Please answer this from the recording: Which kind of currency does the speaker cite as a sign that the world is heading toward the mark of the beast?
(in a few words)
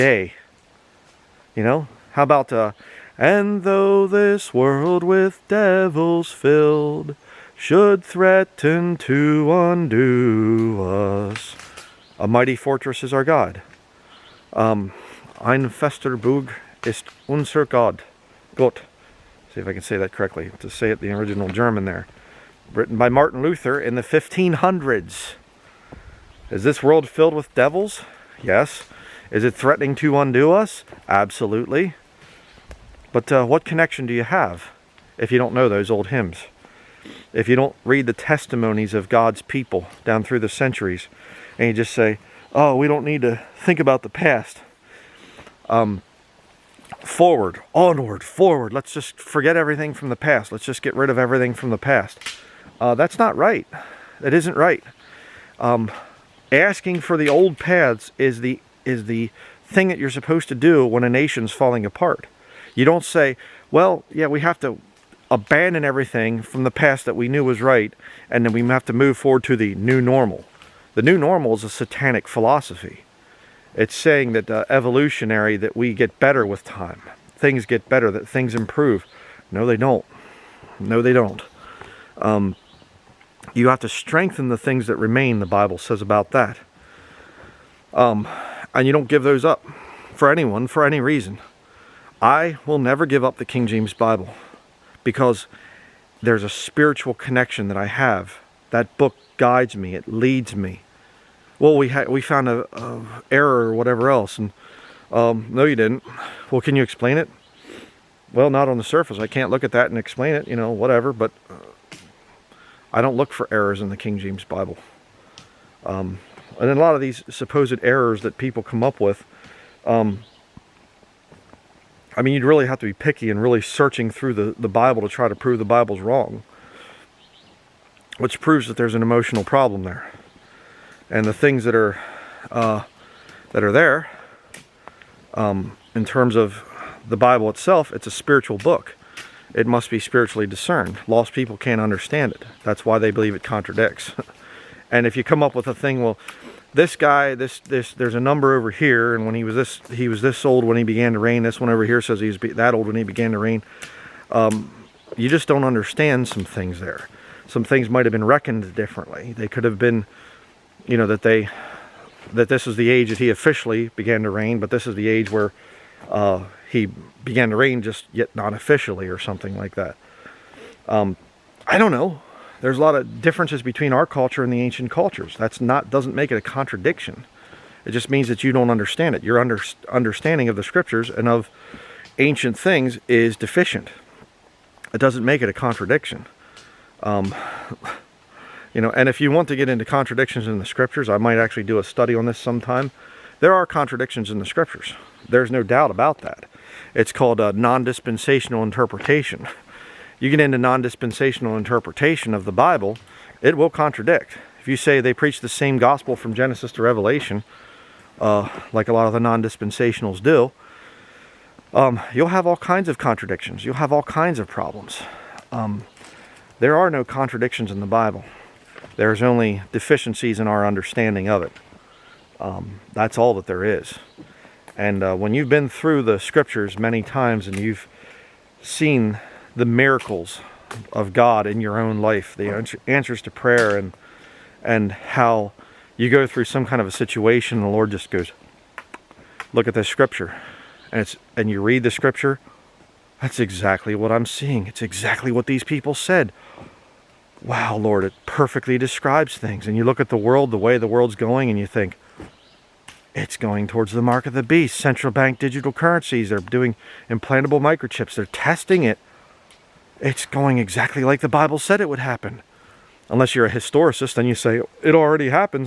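central bank digital currencies.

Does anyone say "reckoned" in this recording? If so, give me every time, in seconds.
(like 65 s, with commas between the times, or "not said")
158 s.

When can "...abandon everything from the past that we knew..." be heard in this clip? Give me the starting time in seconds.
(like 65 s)
65 s.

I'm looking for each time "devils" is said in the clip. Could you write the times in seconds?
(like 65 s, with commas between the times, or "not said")
5 s, 27 s.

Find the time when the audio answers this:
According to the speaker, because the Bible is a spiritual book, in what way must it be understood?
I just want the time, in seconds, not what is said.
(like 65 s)
139 s.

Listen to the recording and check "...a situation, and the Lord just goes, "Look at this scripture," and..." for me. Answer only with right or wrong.
right.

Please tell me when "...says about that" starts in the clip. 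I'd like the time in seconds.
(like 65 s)
85 s.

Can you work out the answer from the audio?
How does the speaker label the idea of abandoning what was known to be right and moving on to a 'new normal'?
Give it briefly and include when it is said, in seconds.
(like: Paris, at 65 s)
satanic philosophy, at 71 s.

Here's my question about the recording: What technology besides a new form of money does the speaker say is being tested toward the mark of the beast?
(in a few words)
implantable microchips.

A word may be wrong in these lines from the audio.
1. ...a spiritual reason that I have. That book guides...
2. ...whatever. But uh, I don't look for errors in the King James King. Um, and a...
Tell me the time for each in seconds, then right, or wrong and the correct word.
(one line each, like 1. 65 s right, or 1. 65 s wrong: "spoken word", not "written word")
1. 96 s wrong: "connection", not "reason"
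2. 110 s wrong: "Bible", not "King".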